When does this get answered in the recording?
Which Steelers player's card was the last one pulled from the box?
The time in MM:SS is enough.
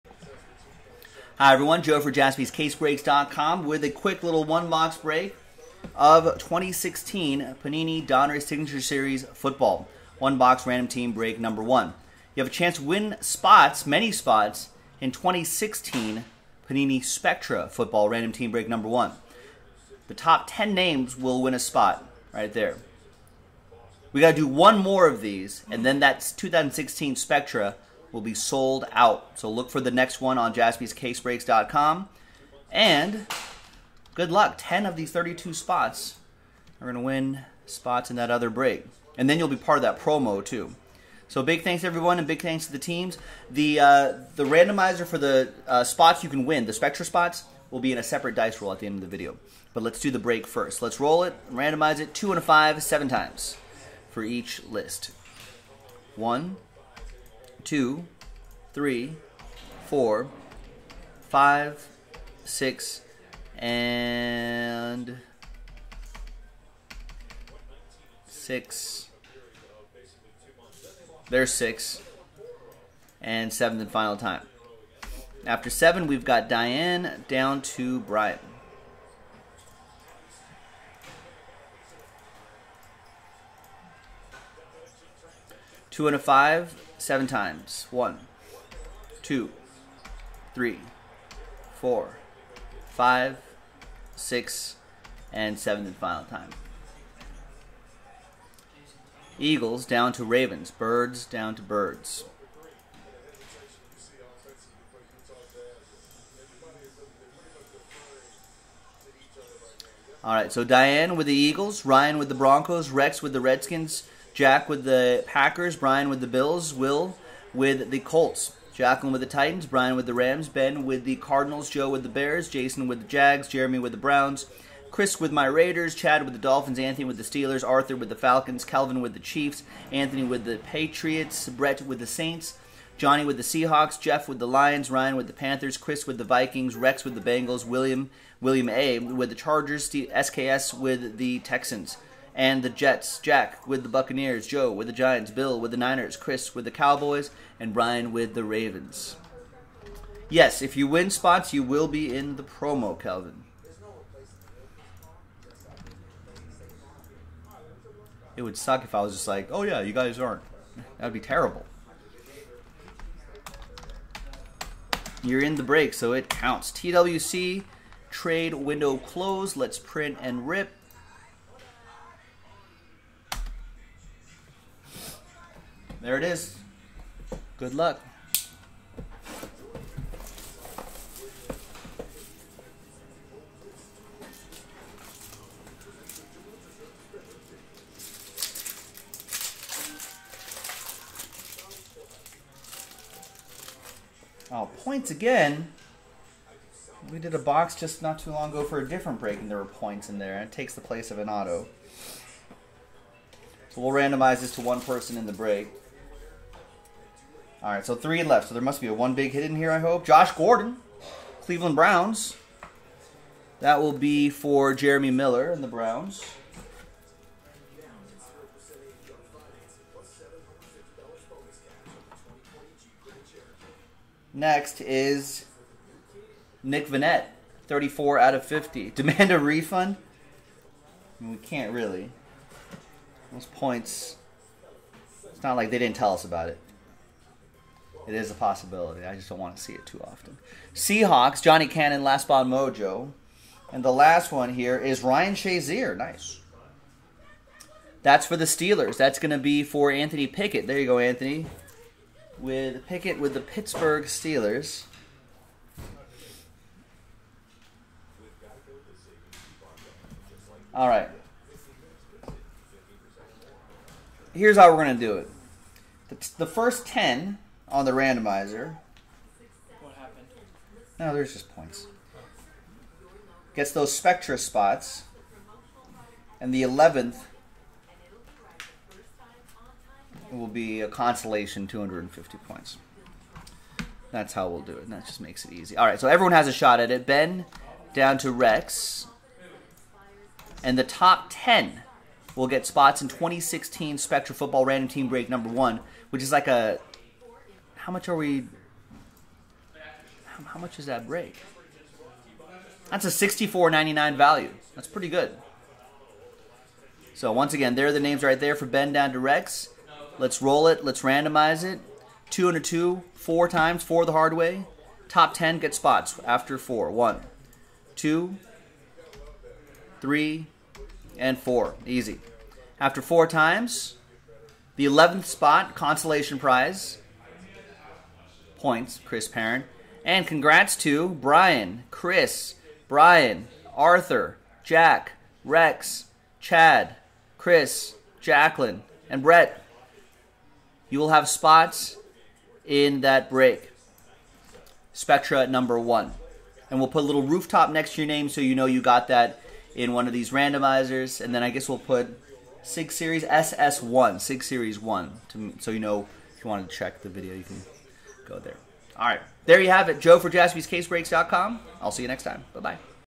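04:05.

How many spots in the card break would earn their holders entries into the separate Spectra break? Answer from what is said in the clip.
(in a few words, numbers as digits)
10.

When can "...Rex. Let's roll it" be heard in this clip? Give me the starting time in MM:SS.
05:09.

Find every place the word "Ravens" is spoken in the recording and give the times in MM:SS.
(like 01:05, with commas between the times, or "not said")
01:40, 02:28.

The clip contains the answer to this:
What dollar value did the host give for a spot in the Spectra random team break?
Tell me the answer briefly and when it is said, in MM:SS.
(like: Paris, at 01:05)
64.99, at 05:03.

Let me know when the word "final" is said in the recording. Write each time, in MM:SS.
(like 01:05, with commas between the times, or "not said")
01:13, 01:35.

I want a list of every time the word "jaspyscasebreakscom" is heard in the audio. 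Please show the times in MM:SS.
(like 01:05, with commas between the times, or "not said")
00:02, 00:30, 06:00.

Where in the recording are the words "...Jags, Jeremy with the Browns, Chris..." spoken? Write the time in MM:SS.
02:03.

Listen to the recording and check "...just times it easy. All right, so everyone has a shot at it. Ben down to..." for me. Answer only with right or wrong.
wrong.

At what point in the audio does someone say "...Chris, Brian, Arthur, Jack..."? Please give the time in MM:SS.
05:31.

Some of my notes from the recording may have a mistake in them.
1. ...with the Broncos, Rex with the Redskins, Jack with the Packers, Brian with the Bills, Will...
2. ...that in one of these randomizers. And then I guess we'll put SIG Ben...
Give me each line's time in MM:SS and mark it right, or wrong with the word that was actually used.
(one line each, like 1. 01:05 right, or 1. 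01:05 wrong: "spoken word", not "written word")
1. 01:52 right
2. 05:49 wrong: "Series", not "Ben".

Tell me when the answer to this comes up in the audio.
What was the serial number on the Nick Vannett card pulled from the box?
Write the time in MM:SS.
03:47.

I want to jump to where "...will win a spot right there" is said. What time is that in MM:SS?
00:21.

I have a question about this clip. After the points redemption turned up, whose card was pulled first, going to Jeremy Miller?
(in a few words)
Josh Gordon.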